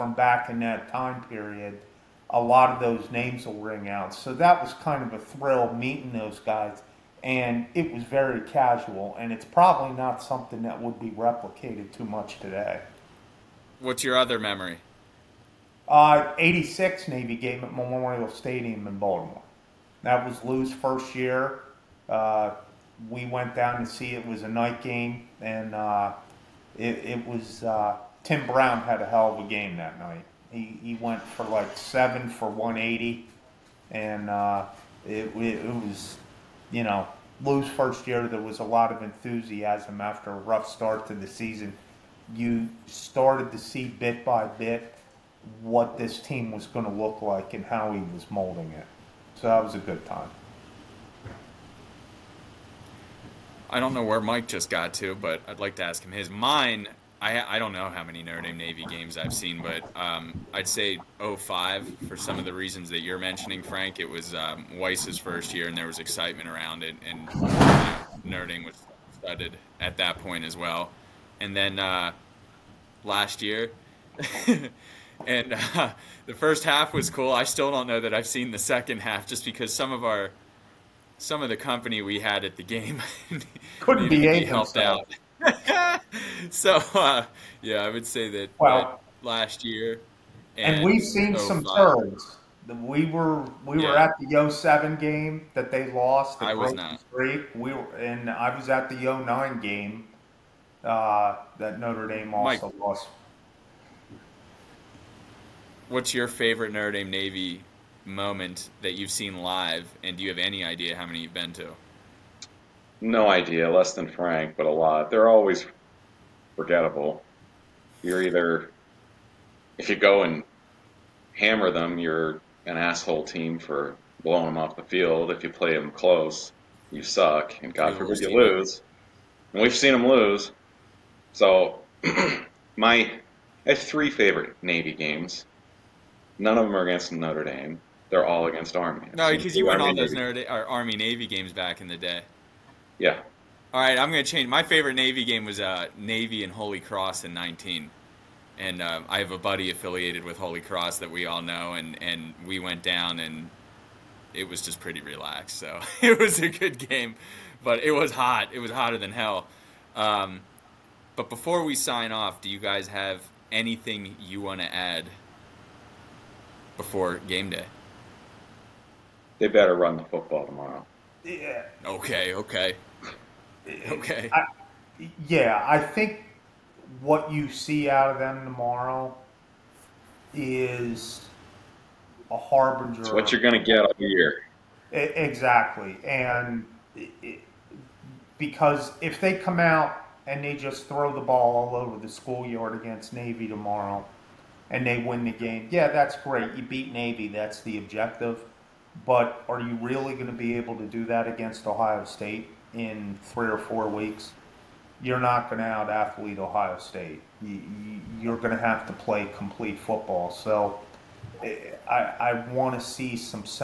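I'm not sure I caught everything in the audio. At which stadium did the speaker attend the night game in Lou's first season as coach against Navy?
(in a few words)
Memorial Stadium.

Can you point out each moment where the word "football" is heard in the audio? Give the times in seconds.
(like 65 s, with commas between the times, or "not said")
170 s, 209 s.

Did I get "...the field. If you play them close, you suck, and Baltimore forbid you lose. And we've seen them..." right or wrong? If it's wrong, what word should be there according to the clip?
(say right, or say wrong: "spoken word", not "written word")
wrong: "God", not "Baltimore".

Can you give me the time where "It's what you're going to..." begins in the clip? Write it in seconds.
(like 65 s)
183 s.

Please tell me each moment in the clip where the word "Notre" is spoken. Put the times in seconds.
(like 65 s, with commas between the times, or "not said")
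58 s, 68 s, 101 s, 106 s, 137 s.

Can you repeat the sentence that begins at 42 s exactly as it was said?
You started to see bit by bit what this team was going to look like and how he was molding it.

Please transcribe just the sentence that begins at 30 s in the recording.
He, he went for like seven for 180, and uh, it, it, was, you know, Lou's first year.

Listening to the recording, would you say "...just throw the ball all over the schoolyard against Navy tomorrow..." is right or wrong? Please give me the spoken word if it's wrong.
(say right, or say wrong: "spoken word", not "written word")
right.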